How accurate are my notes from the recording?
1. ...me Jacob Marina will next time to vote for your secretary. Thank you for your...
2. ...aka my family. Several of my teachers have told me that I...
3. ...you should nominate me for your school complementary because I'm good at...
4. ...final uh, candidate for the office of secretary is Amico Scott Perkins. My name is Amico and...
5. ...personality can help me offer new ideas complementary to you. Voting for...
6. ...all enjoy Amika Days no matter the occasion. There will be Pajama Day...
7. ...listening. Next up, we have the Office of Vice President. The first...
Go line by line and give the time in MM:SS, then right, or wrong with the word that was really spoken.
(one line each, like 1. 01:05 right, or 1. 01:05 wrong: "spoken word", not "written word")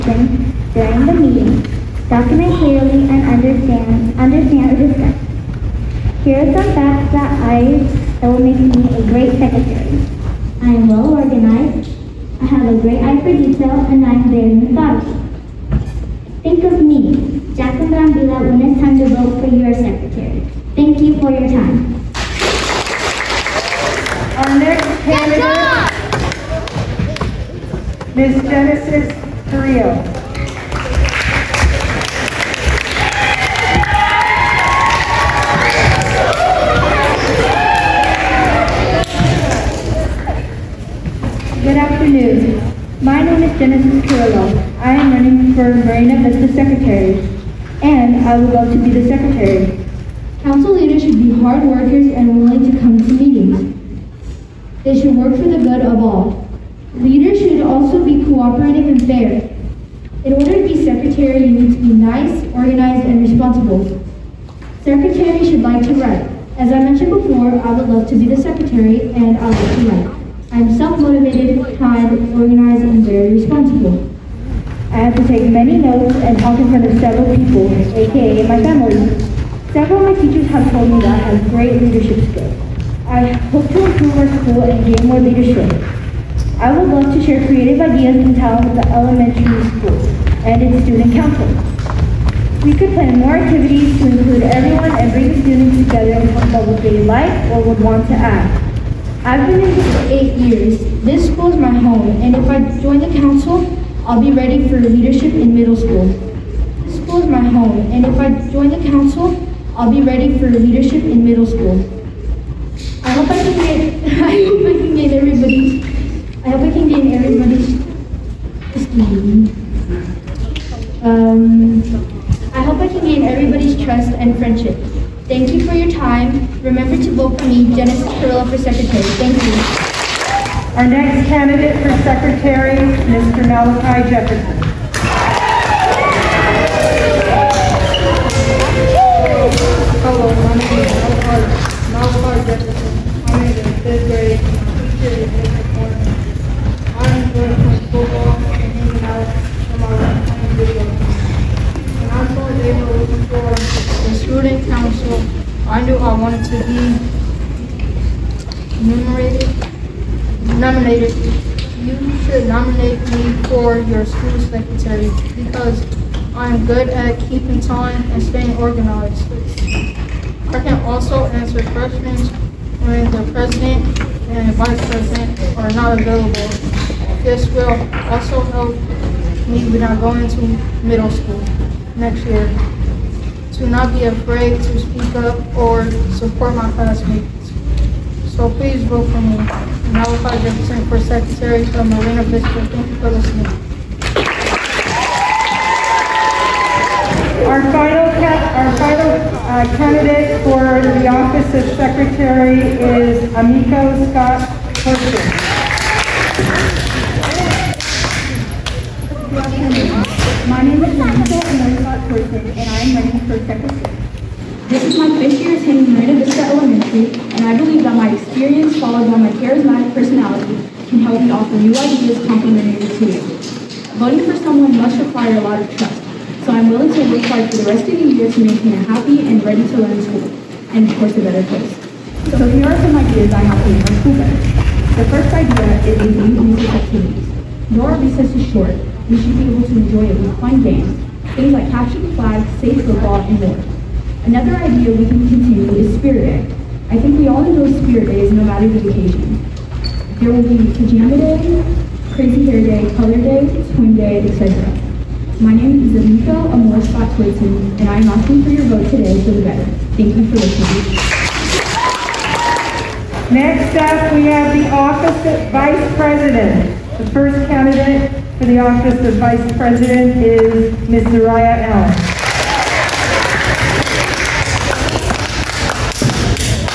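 1. 00:16 wrong: "Villa", not "Marina"
2. 01:17 right
3. 02:41 wrong: "secretary", not "complementary"
4. 03:18 right
5. 03:39 right
6. 04:07 wrong: "Spirit", not "Amika"
7. 04:20 right.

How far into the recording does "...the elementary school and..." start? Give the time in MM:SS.
01:28.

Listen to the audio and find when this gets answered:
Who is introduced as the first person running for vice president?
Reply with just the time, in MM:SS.
04:31.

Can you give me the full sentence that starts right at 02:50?
I can also answer questions when the president and vice president are not available.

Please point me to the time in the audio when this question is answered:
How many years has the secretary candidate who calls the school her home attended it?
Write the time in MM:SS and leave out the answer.
01:40.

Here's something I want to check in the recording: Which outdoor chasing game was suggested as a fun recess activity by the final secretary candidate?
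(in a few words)
Capture the flag.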